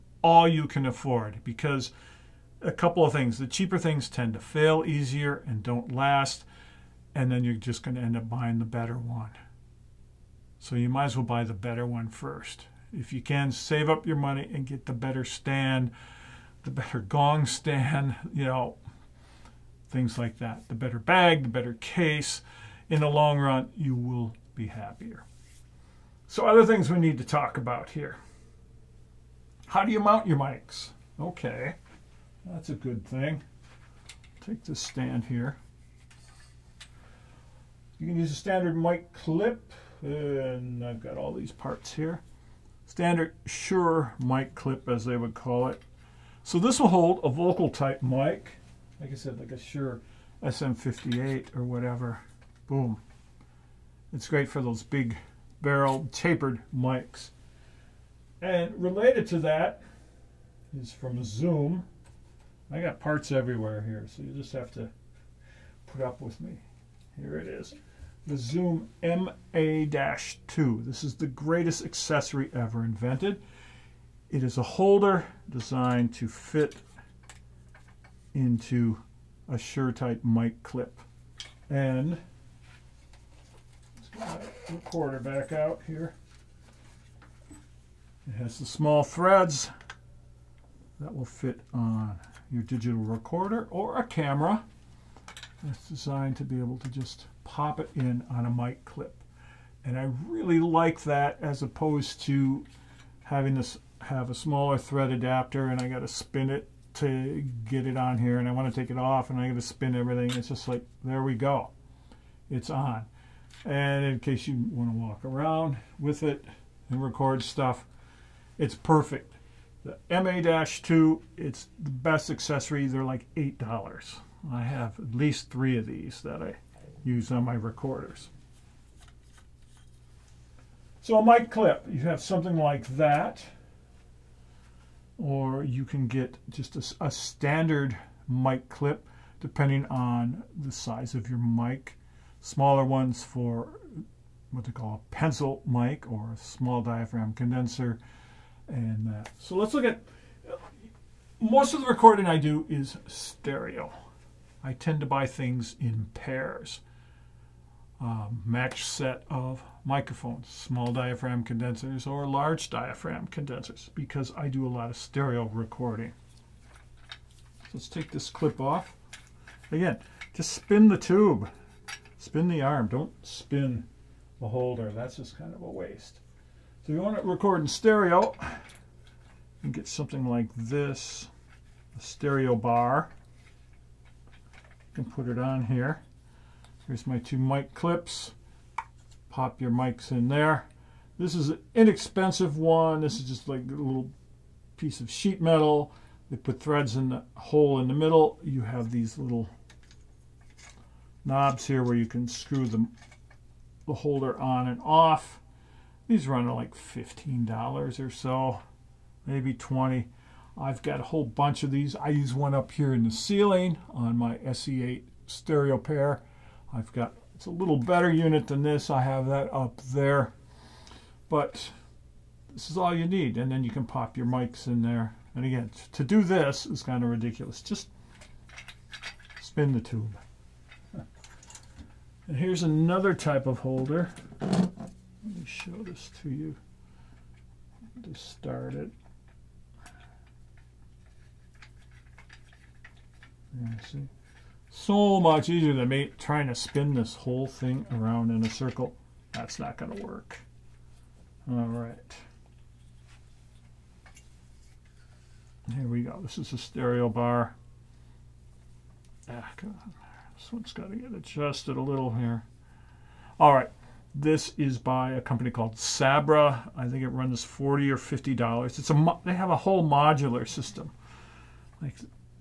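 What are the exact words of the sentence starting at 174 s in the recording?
That's just kind of a waste.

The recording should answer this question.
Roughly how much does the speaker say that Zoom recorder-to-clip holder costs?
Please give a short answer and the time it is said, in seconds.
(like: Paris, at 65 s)
$8, at 123 s.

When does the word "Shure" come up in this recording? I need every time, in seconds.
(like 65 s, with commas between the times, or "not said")
43 s, 49 s.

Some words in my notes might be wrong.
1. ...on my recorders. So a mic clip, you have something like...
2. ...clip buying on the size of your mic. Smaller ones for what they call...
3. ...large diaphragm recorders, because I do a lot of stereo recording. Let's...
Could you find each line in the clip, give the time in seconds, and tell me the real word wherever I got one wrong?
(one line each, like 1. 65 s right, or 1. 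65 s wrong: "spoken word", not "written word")
1. 127 s right
2. 138 s wrong: "depending", not "buying"
3. 162 s wrong: "condensers", not "recorders".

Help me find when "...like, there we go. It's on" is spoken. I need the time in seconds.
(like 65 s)
110 s.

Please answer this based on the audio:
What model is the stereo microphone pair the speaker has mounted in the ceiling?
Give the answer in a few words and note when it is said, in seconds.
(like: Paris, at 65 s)
SE8, at 214 s.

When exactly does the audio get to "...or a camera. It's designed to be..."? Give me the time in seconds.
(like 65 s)
93 s.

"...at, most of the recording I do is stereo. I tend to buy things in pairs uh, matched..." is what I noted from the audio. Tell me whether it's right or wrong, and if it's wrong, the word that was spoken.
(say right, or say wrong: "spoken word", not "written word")
right.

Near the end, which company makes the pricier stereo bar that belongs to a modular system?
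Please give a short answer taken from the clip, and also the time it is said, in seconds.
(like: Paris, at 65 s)
Sabra, at 265 s.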